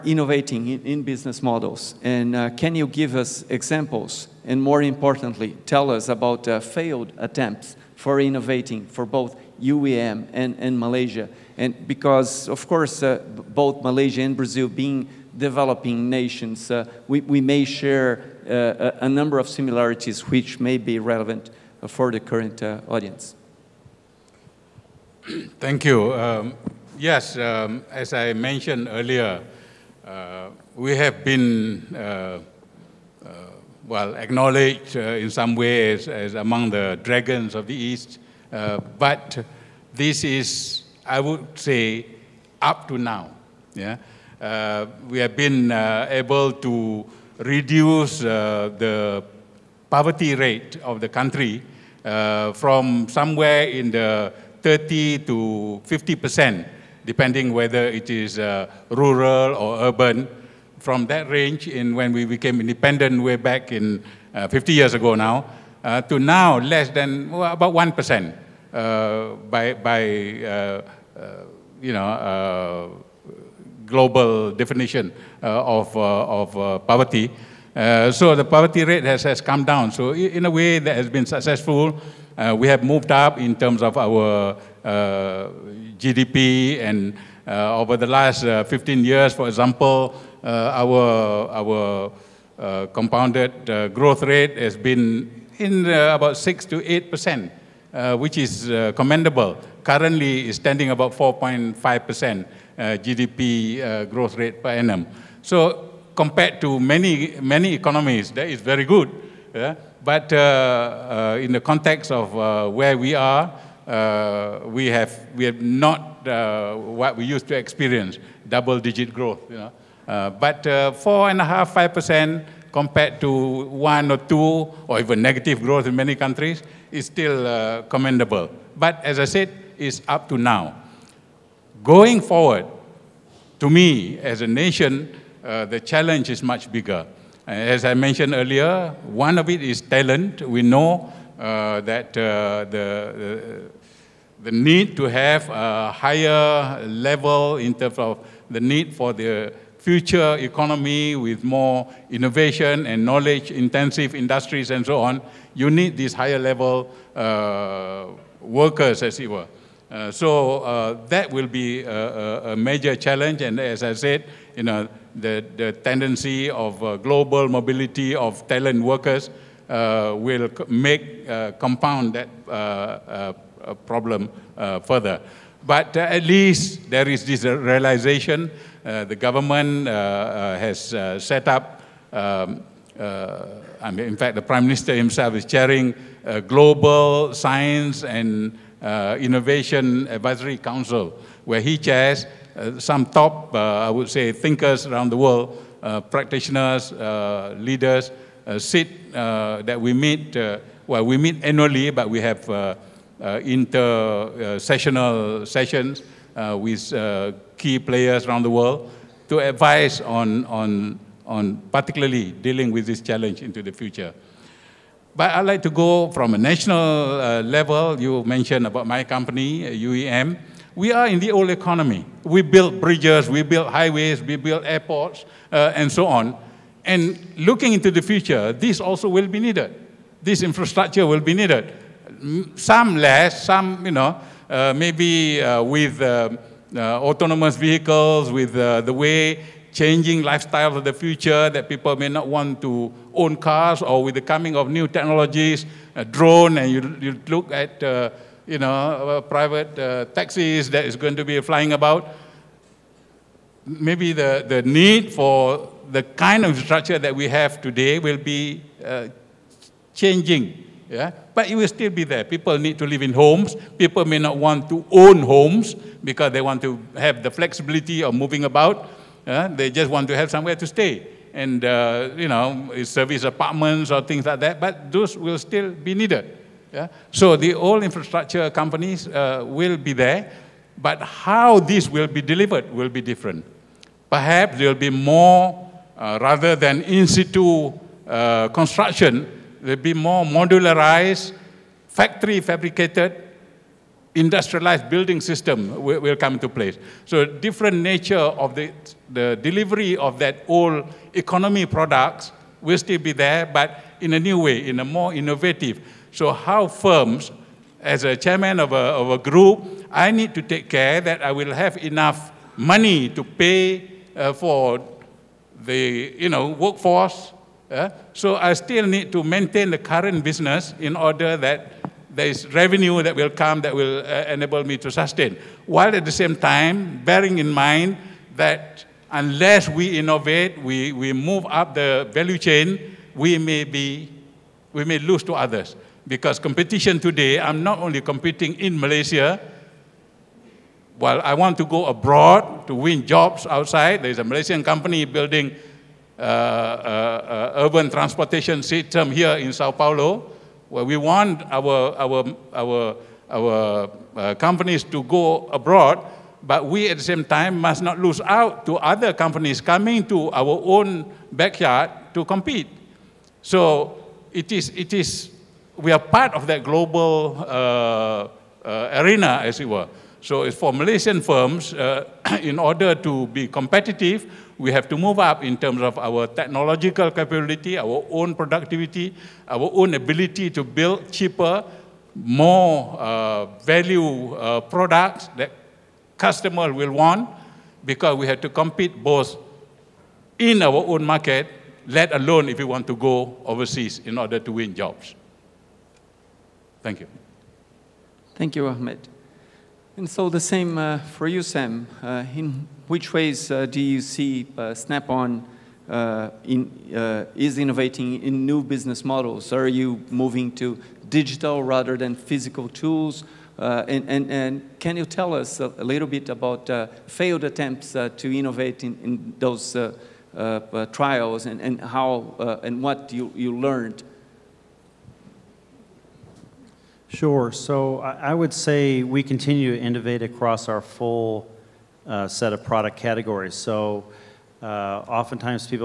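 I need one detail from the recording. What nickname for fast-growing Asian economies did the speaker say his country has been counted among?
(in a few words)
dragons of the East.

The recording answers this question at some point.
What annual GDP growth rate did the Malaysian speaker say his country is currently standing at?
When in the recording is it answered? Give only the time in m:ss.
1:41.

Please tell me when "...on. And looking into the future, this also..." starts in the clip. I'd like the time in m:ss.
3:46.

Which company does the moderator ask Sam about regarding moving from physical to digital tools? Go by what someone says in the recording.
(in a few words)
Snap-on.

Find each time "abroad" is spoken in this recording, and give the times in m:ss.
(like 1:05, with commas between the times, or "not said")
5:41, 5:55.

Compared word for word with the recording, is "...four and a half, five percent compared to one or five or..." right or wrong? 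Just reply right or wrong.
wrong.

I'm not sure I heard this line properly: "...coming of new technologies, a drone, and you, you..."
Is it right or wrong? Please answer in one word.
right.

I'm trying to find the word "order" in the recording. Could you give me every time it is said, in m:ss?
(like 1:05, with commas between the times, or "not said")
5:20, 6:12, 6:34.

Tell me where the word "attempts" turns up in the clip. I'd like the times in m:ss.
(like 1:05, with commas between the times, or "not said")
0:07, 6:57.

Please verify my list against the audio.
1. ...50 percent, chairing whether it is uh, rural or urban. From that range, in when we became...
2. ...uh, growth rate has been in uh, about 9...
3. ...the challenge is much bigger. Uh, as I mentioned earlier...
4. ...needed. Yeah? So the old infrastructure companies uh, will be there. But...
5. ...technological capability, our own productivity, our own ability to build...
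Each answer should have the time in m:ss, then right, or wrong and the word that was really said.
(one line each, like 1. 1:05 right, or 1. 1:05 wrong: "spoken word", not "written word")
1. 0:55 wrong: "depending", not "chairing"
2. 1:33 wrong: "6", not "9"
3. 2:15 right
4. 4:35 right
5. 6:16 right.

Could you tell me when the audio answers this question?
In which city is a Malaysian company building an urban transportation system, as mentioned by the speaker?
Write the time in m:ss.
5:49.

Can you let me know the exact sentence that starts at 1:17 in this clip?
so the poverty rate has, has come down.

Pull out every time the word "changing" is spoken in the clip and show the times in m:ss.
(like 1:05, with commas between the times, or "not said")
3:59, 4:19.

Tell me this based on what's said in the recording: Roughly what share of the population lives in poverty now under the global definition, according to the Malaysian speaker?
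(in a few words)
about 1%.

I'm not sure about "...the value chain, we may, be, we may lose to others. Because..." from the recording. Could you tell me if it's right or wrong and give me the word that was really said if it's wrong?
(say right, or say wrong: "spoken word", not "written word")
right.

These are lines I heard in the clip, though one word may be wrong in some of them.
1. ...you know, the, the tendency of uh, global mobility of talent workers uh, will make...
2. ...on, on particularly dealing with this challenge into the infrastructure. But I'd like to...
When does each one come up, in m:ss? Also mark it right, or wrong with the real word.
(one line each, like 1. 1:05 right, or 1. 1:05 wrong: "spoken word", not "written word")
1. 2:44 right
2. 3:30 wrong: "future", not "infrastructure".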